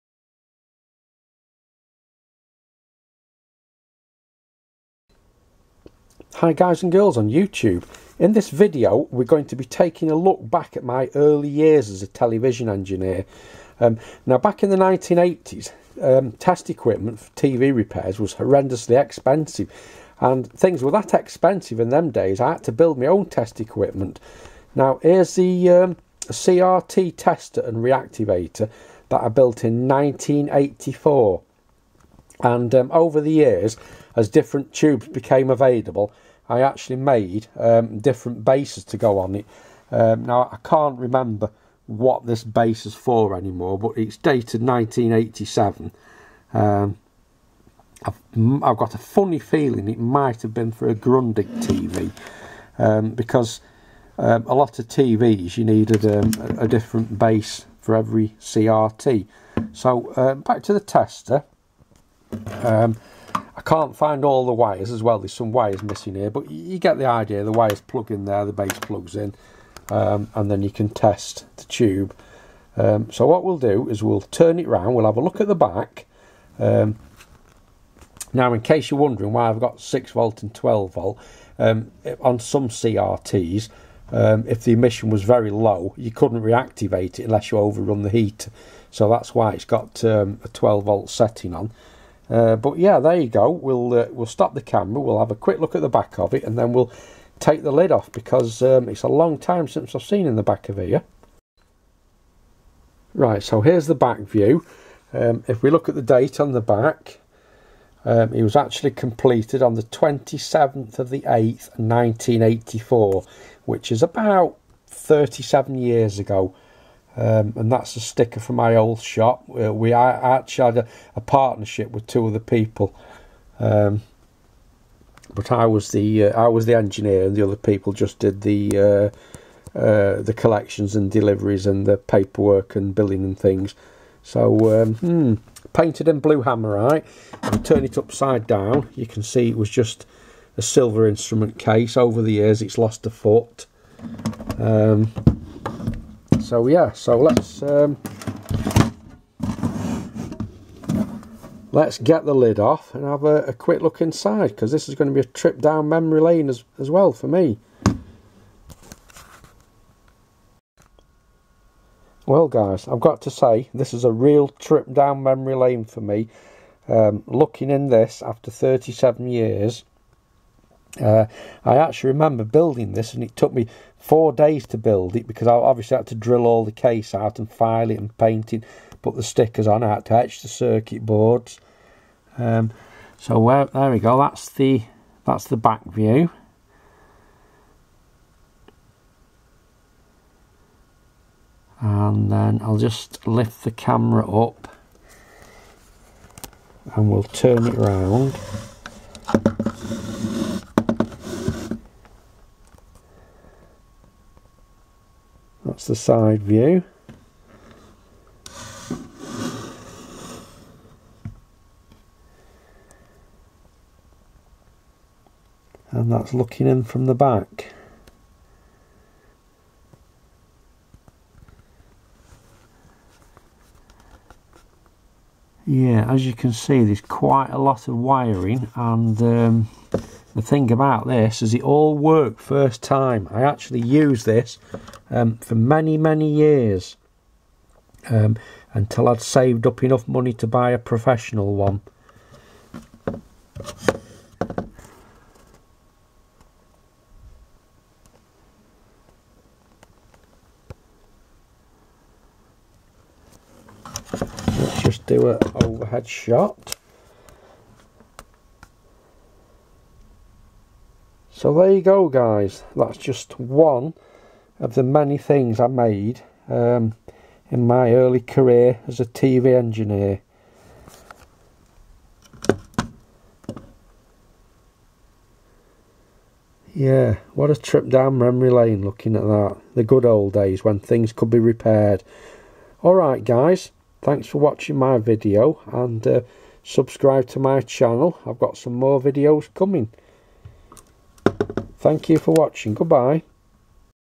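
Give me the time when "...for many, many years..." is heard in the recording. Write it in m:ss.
3:55.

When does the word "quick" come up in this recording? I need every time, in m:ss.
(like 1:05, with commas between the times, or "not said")
1:35, 2:33.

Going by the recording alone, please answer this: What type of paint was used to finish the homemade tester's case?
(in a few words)
blue hammerite.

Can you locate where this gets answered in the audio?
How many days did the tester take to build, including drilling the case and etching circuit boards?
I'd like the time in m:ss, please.
2:53.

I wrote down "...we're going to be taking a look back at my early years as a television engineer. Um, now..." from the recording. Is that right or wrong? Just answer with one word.
right.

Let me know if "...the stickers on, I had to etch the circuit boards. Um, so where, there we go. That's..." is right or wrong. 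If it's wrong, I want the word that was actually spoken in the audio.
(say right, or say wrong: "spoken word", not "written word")
right.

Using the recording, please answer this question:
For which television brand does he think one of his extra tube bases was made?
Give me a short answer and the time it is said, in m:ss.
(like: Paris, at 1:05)
Grundig, at 0:50.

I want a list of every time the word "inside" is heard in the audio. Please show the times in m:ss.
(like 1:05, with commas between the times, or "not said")
2:34.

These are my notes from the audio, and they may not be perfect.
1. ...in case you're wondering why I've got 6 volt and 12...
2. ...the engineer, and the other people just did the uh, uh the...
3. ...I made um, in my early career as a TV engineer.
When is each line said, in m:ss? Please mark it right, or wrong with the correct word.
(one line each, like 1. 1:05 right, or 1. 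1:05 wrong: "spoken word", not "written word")
1. 1:18 right
2. 2:06 right
3. 4:25 right.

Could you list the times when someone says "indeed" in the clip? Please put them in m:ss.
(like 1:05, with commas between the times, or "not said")
not said.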